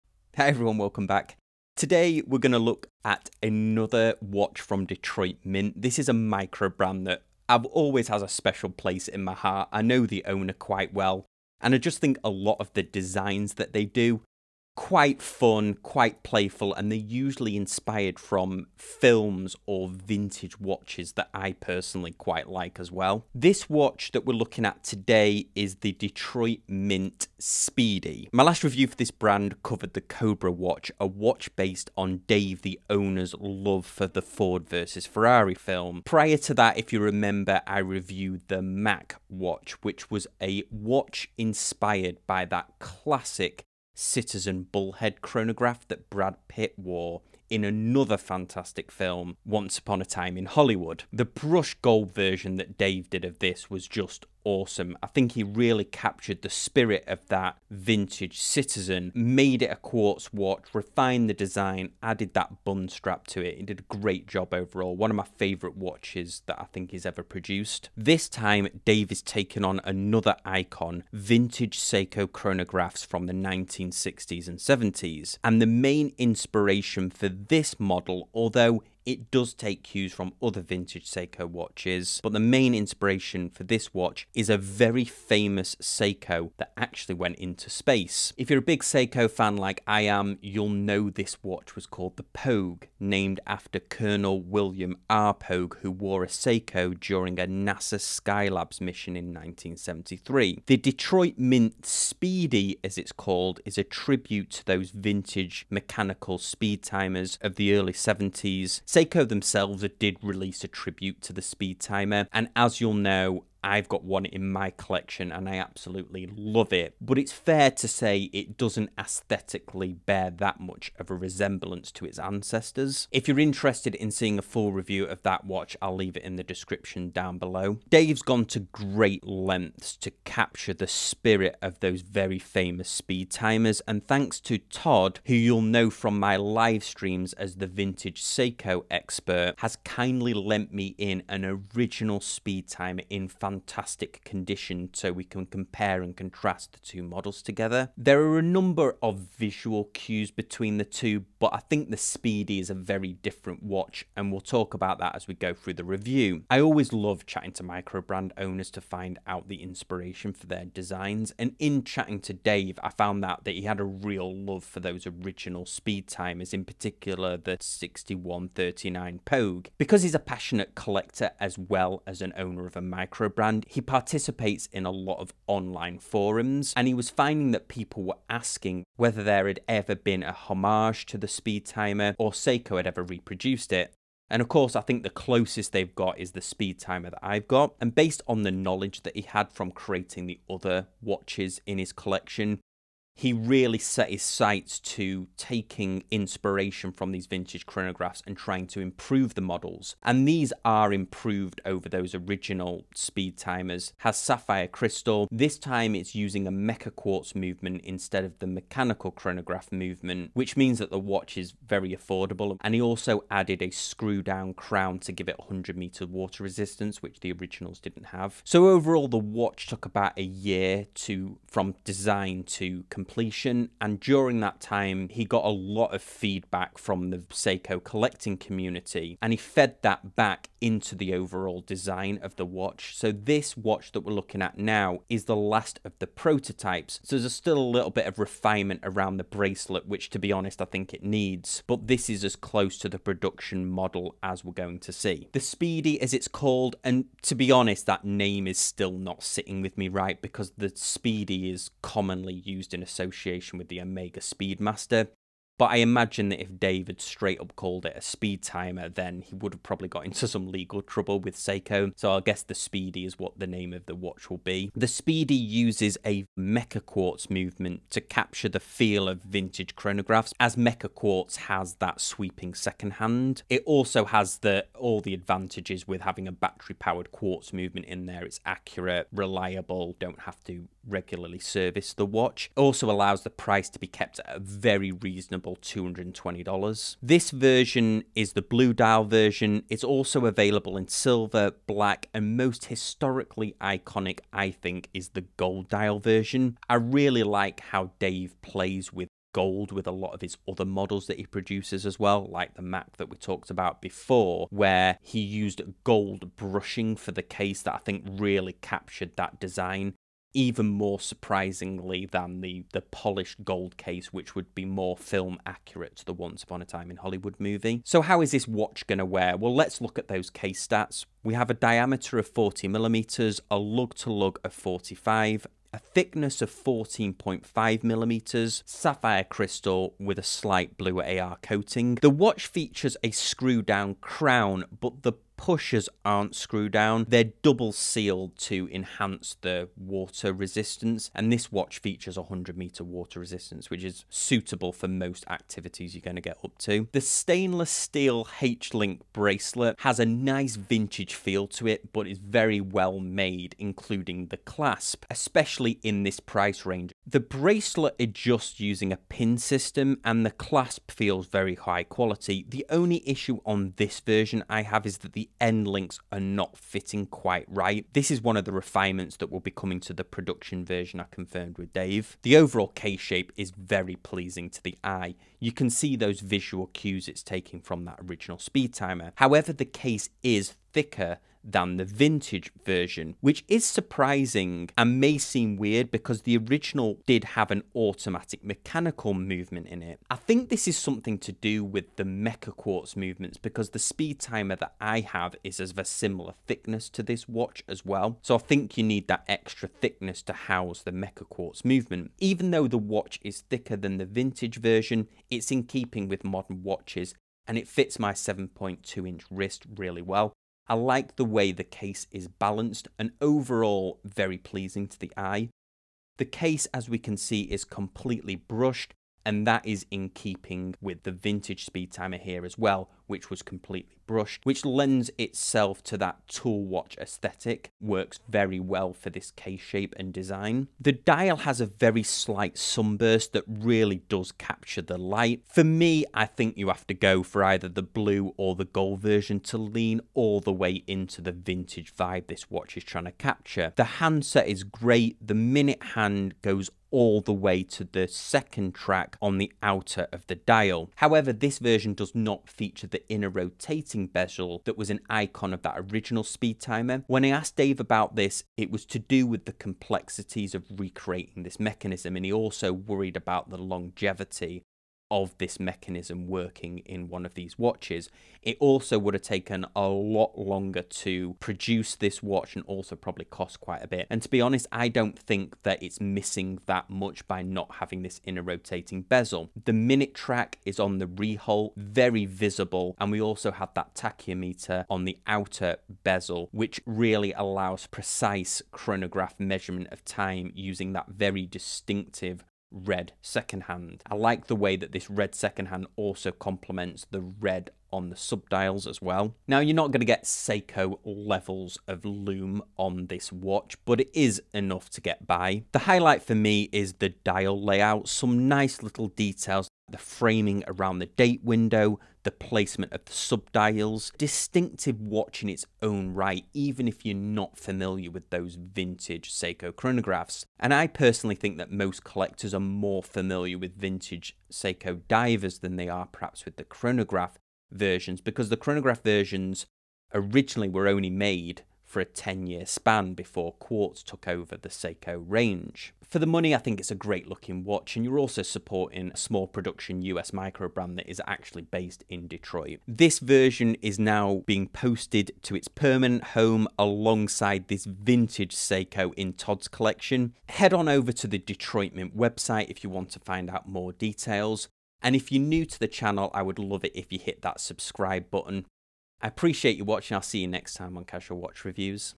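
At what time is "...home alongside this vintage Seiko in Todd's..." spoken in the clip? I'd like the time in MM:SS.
09:06.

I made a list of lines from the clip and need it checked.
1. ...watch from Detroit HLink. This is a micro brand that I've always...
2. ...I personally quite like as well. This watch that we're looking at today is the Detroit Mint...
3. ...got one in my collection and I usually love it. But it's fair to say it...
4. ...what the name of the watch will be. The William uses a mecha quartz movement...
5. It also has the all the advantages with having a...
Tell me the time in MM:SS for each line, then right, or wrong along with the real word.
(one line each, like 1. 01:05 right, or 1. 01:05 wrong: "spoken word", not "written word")
1. 00:04 wrong: "Mint", not "HLink"
2. 00:21 right
3. 01:53 wrong: "absolutely", not "usually"
4. 04:23 wrong: "Speedy", not "William"
5. 04:33 right.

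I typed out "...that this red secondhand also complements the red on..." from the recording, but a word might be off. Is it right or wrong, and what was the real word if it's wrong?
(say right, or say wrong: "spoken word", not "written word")
right.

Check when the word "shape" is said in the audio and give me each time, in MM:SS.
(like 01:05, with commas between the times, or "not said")
06:12, 07:09.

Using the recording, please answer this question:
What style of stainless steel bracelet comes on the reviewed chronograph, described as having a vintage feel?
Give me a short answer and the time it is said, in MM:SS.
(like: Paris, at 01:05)
H-Link, at 05:48.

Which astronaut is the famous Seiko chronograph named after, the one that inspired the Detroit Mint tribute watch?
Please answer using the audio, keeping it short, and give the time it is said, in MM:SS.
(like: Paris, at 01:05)
William R. 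Pogue, at 01:34.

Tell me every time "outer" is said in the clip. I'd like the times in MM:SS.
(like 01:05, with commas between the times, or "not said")
07:29, 08:05.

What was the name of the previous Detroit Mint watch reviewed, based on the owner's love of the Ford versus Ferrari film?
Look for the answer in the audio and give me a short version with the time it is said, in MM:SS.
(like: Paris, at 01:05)
Cobra, at 00:30.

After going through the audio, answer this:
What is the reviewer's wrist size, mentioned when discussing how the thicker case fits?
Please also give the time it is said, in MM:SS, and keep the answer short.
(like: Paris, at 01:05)
7.2 inches, at 06:48.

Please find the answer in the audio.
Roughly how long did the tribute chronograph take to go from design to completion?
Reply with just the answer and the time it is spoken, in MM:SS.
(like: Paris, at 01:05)
About a year, at 03:39.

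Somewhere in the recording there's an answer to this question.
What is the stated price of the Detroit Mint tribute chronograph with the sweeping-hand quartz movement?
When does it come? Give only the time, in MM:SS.
04:45.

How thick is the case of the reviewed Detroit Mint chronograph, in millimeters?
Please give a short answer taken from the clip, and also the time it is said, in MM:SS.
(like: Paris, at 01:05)
14.5 mm, at 05:26.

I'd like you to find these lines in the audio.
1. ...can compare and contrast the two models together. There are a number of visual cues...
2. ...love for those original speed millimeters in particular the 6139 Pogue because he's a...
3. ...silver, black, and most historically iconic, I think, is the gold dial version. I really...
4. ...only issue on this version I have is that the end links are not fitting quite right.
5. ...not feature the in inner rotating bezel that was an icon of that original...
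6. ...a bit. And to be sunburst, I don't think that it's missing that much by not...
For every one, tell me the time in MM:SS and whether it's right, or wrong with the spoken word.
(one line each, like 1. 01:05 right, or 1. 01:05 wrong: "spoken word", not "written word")
1. 02:25 right
2. 02:44 wrong: "timers", not "millimeters"
3. 04:50 right
4. 06:02 right
5. 07:32 right
6. 07:53 wrong: "honest", not "sunburst".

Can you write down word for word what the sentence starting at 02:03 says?
If you're interested in seeing a full review of that watch, I'll leave it in the description down below.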